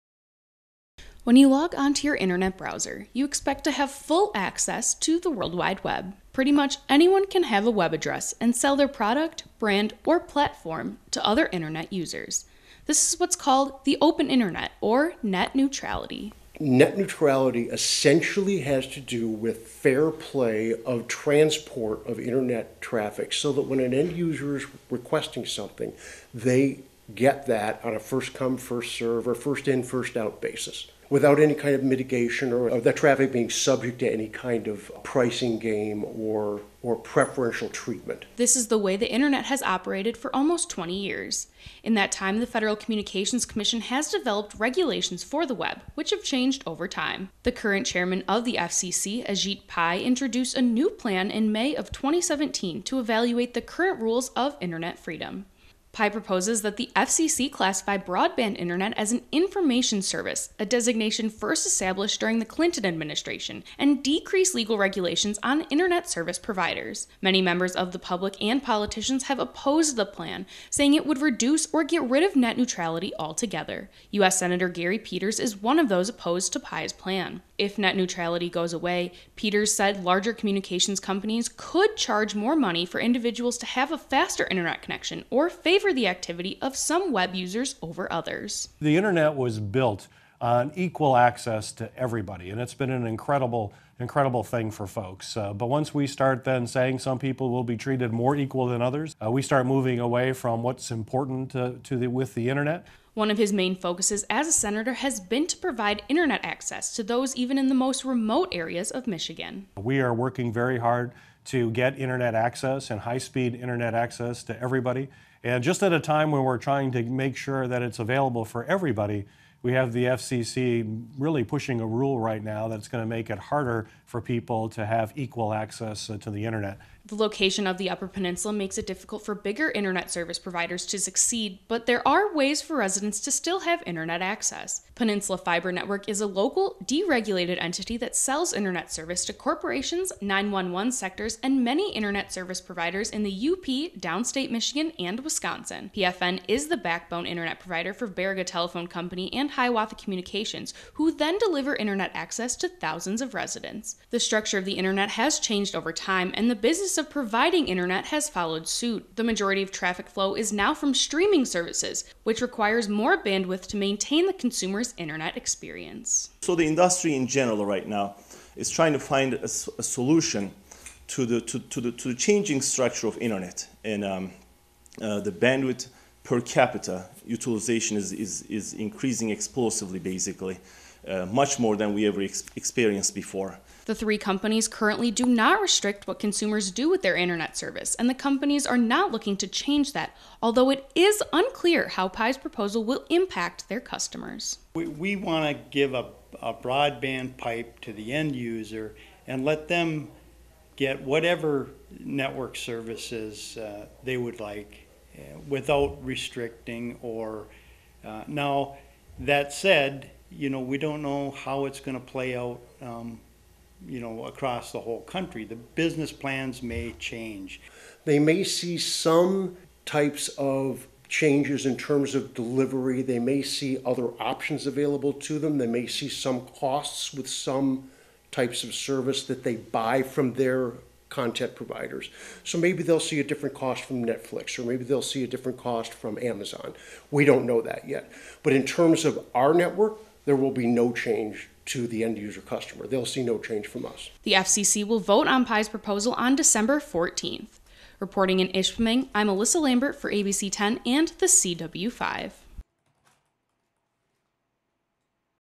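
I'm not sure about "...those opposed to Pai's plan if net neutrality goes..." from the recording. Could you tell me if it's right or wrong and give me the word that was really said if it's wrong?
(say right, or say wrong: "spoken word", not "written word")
right.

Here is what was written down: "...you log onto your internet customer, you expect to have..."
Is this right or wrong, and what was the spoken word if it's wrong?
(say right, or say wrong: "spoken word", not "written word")
wrong: "browser", not "customer".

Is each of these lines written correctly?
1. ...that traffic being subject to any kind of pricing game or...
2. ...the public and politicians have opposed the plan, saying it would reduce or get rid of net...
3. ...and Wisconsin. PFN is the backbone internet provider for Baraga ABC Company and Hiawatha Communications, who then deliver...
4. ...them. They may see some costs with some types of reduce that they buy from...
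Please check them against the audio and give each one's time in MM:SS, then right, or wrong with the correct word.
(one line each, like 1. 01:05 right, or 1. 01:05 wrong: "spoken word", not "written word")
1. 00:32 right
2. 01:07 right
3. 02:24 wrong: "Telephone", not "ABC"
4. 03:45 wrong: "service", not "reduce".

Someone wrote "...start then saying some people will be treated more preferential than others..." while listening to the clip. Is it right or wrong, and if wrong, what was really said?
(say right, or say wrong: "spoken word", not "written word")
wrong: "equal", not "preferential".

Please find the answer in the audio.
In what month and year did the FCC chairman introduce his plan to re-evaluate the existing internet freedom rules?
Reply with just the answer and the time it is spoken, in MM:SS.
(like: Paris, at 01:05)
May 2017, at 00:51.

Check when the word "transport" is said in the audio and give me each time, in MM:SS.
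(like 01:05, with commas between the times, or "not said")
00:21.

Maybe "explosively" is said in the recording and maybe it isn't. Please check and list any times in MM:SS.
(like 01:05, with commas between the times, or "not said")
02:59.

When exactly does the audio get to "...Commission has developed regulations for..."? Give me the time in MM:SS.
00:43.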